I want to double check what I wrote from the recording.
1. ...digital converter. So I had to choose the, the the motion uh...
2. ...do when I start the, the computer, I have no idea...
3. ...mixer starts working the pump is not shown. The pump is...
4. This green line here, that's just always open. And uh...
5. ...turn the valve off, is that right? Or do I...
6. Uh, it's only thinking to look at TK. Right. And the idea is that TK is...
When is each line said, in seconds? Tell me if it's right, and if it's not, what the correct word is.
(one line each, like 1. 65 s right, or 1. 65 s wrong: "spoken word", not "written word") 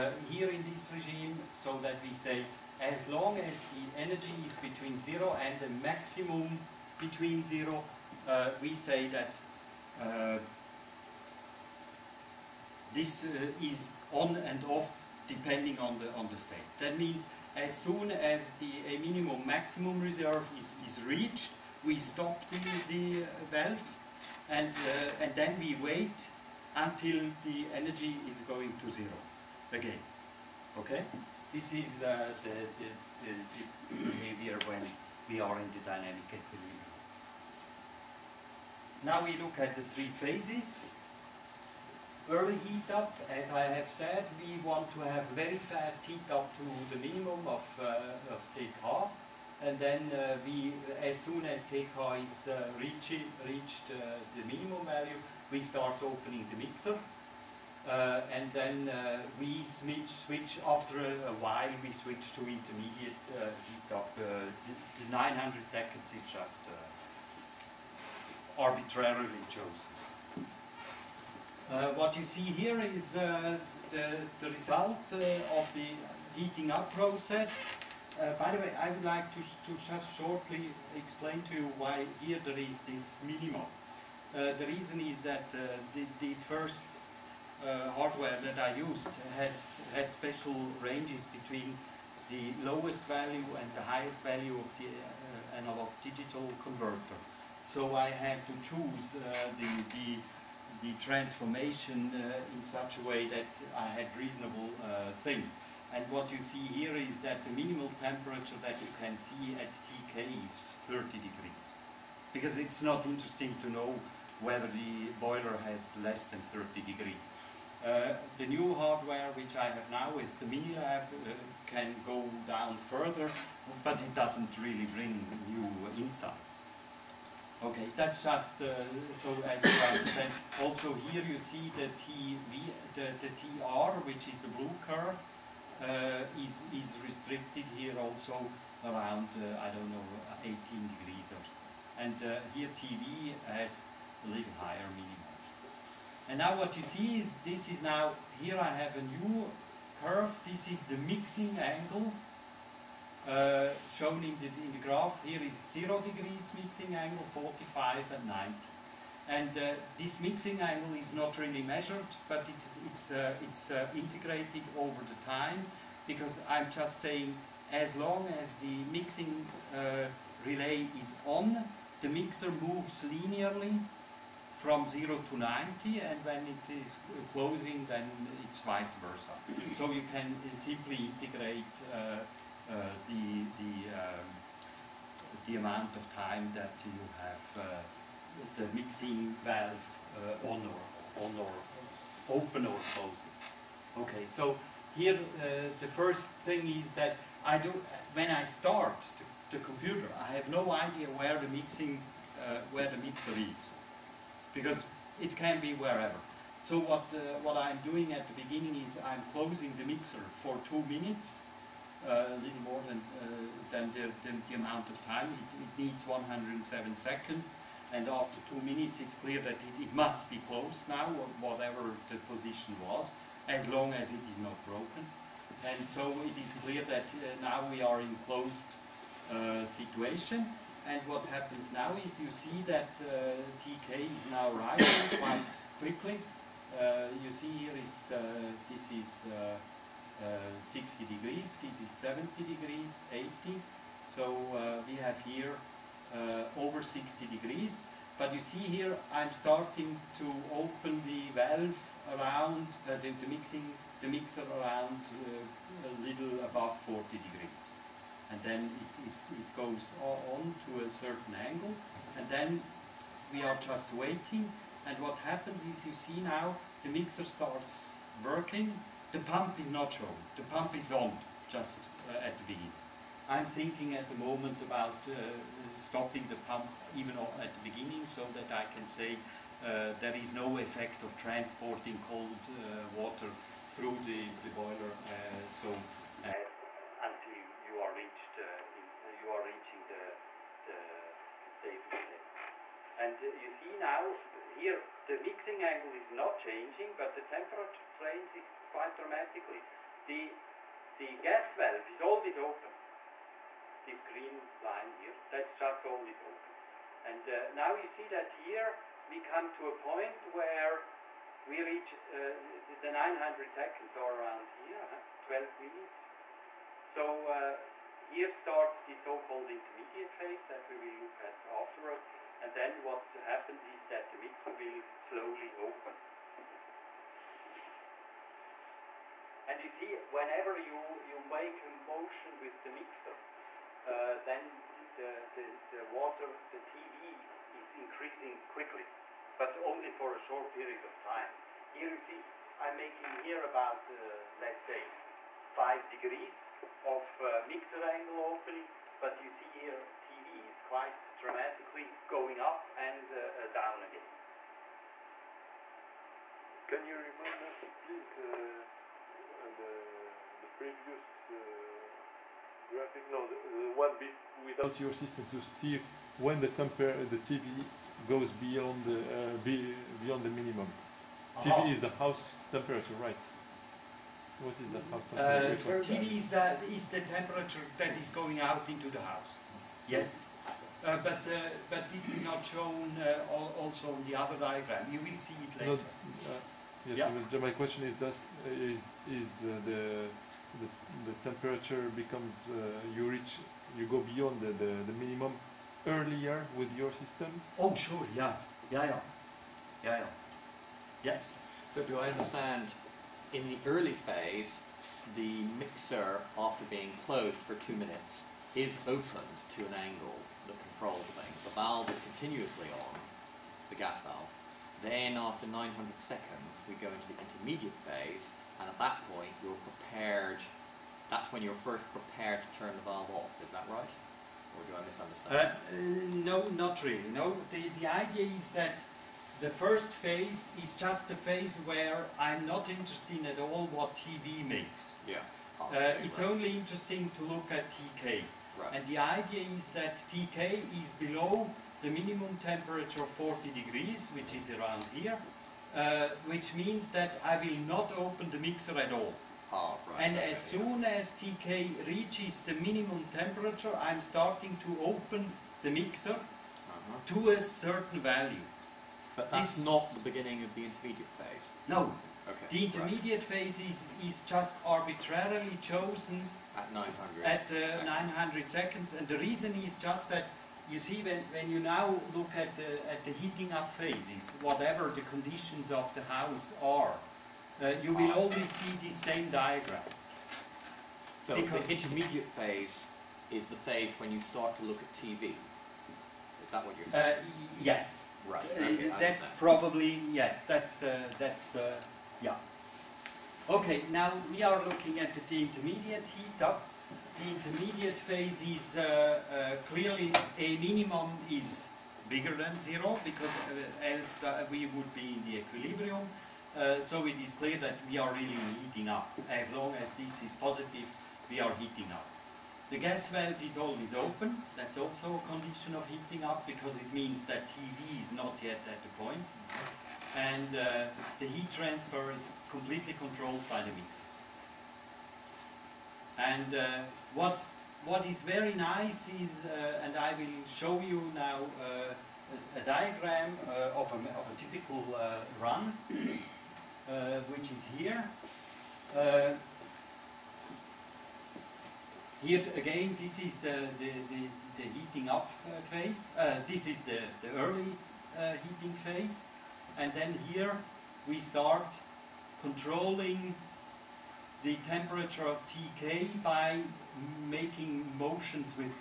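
1. 96 s wrong: "transformation", not "motion"
2. 197 s right
3. 266 s right
4. 303 s right
5. 422 s right
6. 435 s wrong: "interesting", not "thinking".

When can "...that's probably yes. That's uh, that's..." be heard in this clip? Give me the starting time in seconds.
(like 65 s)
488 s.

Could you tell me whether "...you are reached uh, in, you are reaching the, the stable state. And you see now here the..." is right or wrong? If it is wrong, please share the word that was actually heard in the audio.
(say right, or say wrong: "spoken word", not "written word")
right.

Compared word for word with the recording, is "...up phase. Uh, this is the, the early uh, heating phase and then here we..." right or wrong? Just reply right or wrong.
right.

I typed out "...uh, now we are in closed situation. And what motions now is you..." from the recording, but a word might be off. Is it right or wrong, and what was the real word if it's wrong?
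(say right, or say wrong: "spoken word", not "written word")
wrong: "happens", not "motions".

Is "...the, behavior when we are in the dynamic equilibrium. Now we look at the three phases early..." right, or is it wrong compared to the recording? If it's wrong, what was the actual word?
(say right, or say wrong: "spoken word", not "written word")
right.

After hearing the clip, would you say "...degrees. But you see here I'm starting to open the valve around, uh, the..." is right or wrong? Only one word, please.
right.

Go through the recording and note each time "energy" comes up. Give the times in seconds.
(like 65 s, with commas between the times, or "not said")
3 s, 27 s.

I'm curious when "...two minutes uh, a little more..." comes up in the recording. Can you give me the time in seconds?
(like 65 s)
210 s.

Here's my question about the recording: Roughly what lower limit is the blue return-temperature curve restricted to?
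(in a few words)
18 degrees.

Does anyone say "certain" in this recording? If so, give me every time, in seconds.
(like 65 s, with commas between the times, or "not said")
260 s, 457 s.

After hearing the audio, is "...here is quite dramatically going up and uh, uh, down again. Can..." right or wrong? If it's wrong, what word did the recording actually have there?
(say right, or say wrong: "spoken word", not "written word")
right.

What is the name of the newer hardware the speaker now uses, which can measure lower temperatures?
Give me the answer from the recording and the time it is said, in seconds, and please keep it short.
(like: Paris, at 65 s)
Minilab, at 120 s.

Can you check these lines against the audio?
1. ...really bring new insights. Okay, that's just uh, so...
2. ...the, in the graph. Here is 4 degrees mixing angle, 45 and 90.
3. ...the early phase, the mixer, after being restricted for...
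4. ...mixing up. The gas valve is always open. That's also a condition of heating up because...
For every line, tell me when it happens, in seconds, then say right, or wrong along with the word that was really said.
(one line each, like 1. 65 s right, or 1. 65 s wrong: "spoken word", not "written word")
1. 124 s right
2. 154 s wrong: "0", not "4"
3. 403 s wrong: "closed", not "restricted"
4. 511 s wrong: "heating", not "mixing".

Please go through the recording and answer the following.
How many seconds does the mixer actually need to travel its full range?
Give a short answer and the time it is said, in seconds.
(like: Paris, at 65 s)
107, at 216 s.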